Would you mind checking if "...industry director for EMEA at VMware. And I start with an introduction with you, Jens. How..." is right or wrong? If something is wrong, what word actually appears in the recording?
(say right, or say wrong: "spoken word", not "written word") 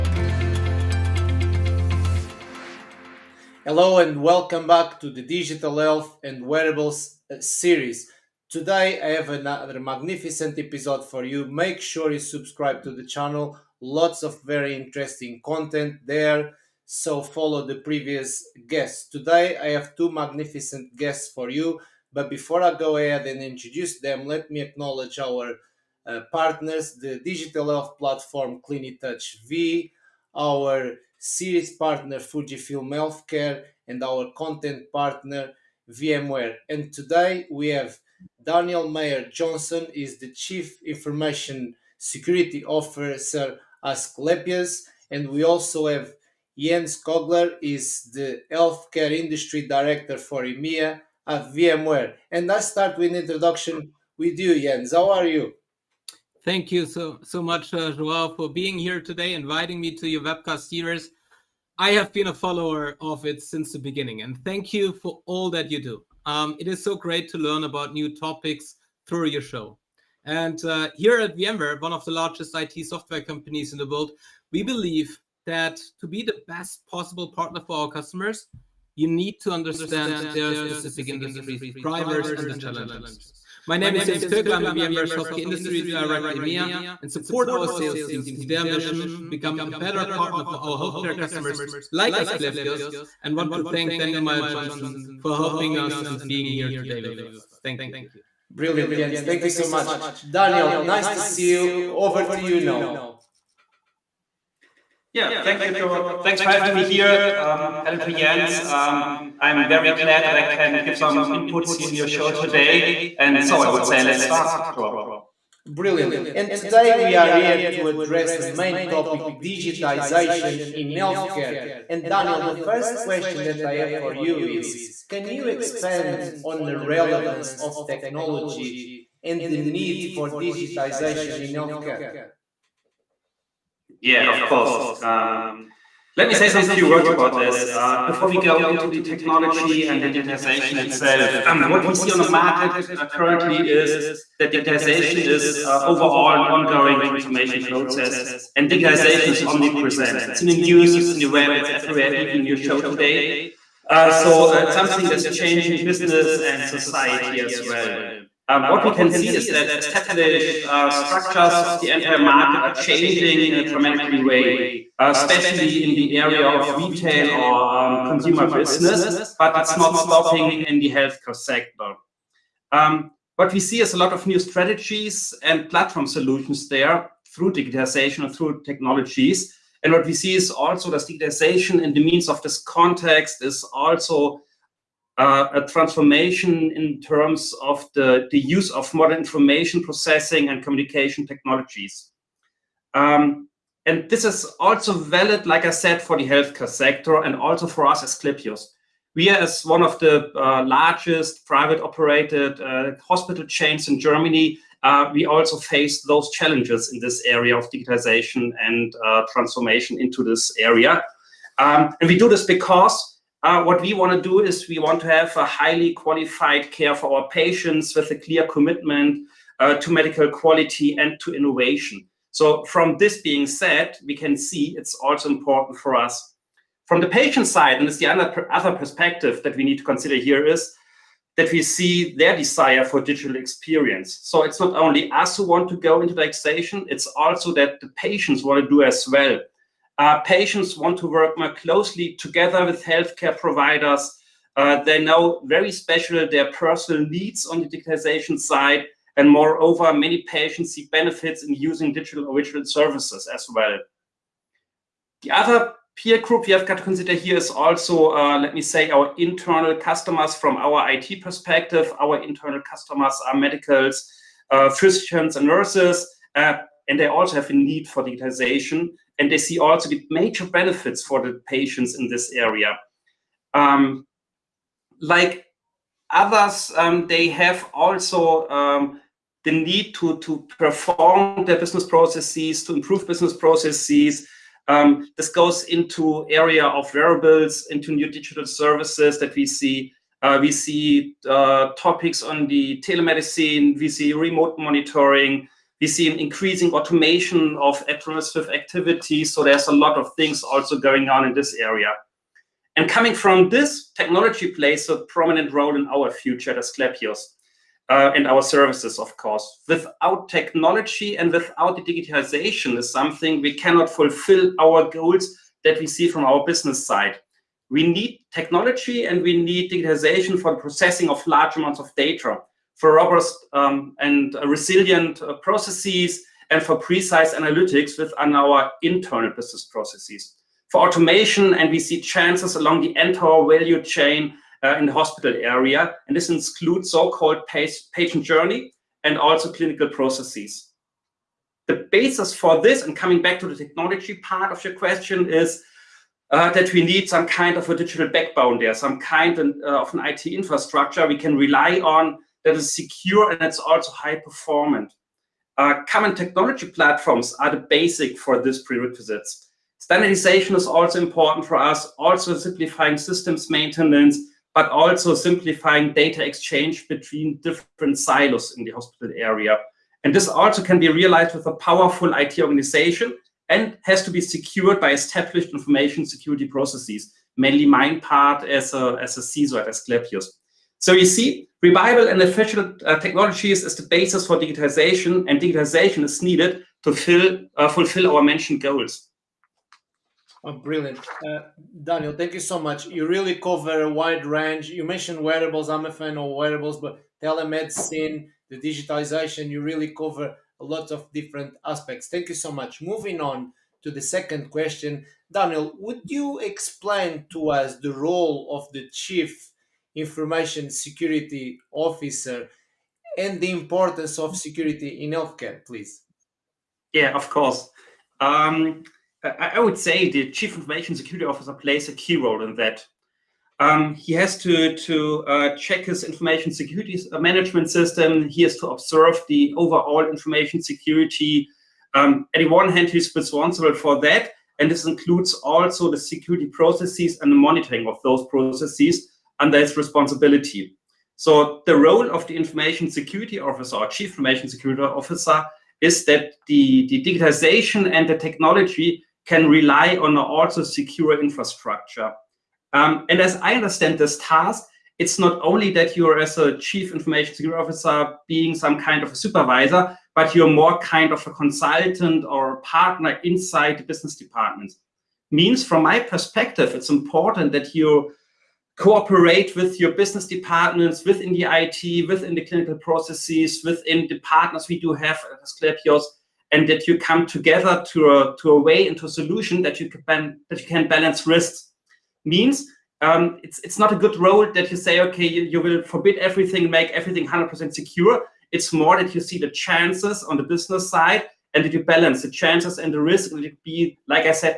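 right.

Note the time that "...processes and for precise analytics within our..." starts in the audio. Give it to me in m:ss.
5:25.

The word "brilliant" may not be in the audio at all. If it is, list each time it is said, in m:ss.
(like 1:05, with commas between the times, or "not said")
1:38, 1:55, 6:30.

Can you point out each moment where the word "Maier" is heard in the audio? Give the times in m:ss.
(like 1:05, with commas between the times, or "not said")
0:38, 1:34.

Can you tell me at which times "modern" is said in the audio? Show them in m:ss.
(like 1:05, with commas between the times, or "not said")
3:08.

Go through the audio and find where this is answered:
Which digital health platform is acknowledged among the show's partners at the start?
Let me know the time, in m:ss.
0:28.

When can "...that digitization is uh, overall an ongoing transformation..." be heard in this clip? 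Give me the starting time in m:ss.
2:24.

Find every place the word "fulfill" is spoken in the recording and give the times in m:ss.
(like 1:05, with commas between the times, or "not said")
5:13, 6:27.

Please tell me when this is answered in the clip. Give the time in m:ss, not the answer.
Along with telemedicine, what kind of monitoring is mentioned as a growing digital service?
4:54.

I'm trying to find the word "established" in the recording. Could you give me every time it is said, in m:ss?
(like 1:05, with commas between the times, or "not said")
2:39, 6:14.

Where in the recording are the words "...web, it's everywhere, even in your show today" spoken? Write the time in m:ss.
2:31.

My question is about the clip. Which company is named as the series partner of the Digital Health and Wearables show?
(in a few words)
Fujifilm Healthcare.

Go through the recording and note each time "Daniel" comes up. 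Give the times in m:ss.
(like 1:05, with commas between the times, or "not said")
0:38, 1:33, 1:40, 2:02, 6:31, 6:45.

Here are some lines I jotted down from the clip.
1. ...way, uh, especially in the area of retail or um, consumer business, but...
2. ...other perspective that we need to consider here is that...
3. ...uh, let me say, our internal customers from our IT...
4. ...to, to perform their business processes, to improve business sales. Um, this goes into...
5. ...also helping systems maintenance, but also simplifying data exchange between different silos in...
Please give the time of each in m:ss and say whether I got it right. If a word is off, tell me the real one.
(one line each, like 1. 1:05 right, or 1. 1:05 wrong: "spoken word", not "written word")
1. 2:44 right
2. 3:48 right
3. 4:18 right
4. 4:39 wrong: "processes", not "sales"
5. 6:01 wrong: "simplifying", not "helping".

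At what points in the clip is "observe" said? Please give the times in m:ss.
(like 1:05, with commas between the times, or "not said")
7:08.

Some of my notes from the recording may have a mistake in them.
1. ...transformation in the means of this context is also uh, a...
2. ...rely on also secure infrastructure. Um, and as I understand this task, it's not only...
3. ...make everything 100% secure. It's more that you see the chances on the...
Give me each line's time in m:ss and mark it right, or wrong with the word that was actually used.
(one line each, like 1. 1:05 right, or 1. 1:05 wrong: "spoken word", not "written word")
1. 3:01 wrong: "digitization", not "transformation"
2. 7:29 right
3. 8:06 right.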